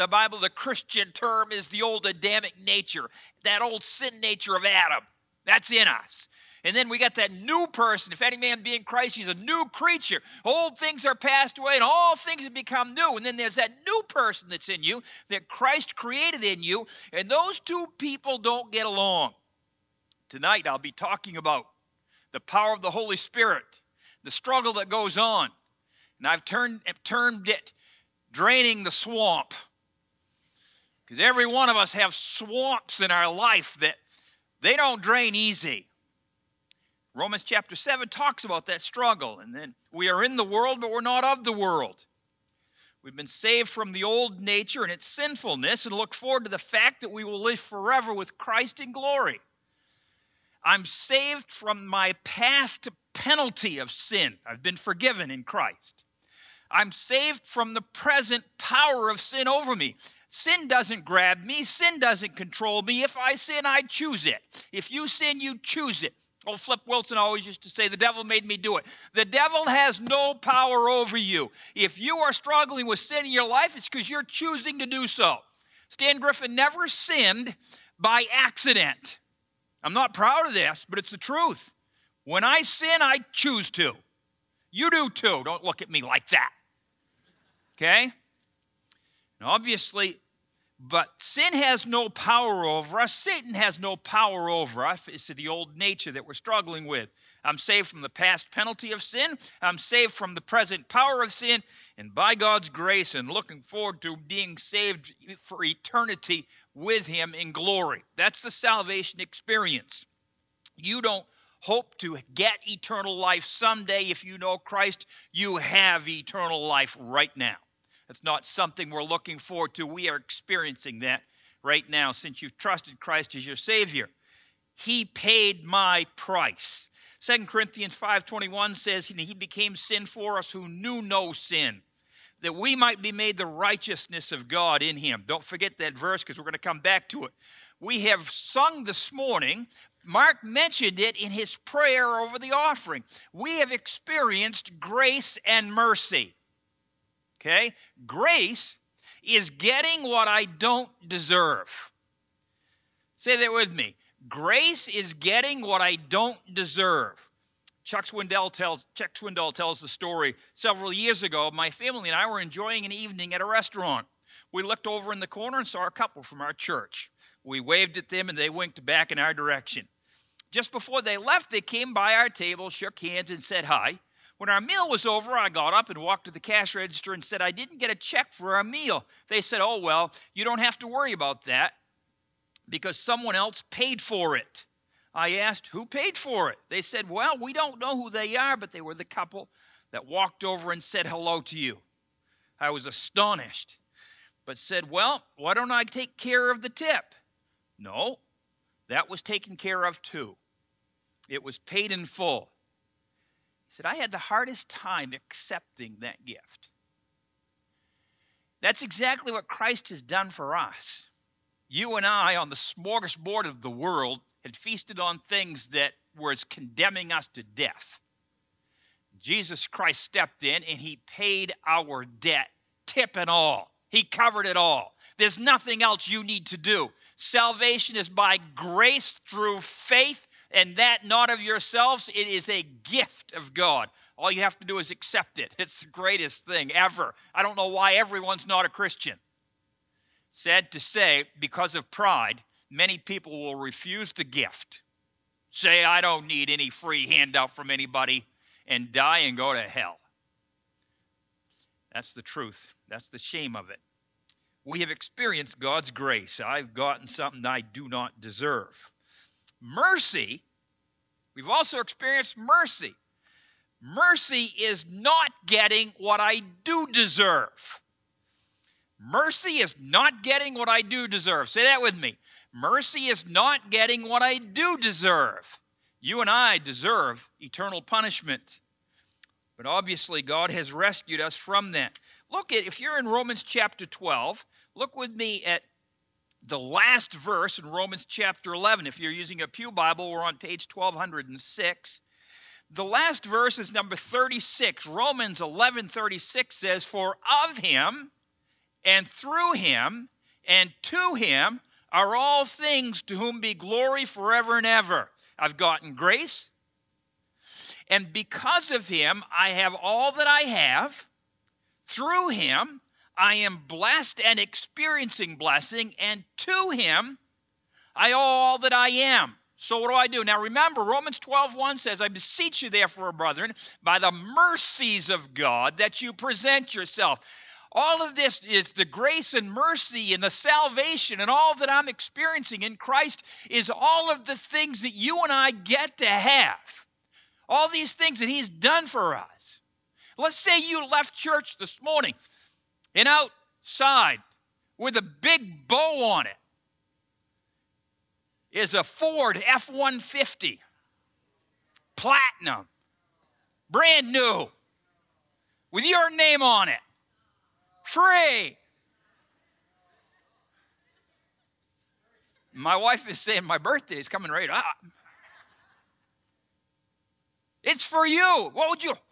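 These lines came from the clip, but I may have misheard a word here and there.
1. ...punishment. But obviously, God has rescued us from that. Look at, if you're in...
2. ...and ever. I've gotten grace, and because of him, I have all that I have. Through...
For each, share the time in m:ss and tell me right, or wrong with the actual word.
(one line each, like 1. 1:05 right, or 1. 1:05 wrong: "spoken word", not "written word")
1. 4:37 right
2. 5:04 right.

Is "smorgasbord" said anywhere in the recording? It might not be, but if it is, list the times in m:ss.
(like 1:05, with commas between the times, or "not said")
3:32.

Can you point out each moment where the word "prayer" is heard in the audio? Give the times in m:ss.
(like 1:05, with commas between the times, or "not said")
2:21.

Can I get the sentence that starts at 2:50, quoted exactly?
Just before they left, they came by our table, shook hands, and said hi.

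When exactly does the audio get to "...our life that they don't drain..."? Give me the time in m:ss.
0:33.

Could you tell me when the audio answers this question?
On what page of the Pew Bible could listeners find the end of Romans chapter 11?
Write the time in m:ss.
4:50.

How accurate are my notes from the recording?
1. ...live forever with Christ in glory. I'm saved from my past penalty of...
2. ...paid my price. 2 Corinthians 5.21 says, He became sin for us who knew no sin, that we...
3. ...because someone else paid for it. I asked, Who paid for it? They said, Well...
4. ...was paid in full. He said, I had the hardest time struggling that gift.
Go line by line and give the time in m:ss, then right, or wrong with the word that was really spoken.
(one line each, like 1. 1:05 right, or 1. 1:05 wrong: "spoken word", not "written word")
1. 0:47 right
2. 2:05 right
3. 3:02 right
4. 3:21 wrong: "accepting", not "struggling".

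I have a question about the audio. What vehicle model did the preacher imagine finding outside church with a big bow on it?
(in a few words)
Ford F-150.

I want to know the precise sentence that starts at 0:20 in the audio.
Tonight I'll be talking about the power of the Holy Spirit, the struggle that goes on.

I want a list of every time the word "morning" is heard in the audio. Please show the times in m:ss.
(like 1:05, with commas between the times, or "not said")
2:19, 5:41.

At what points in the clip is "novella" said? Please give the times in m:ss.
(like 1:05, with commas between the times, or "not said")
not said.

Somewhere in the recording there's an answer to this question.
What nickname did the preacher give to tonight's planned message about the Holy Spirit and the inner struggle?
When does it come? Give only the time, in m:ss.
0:28.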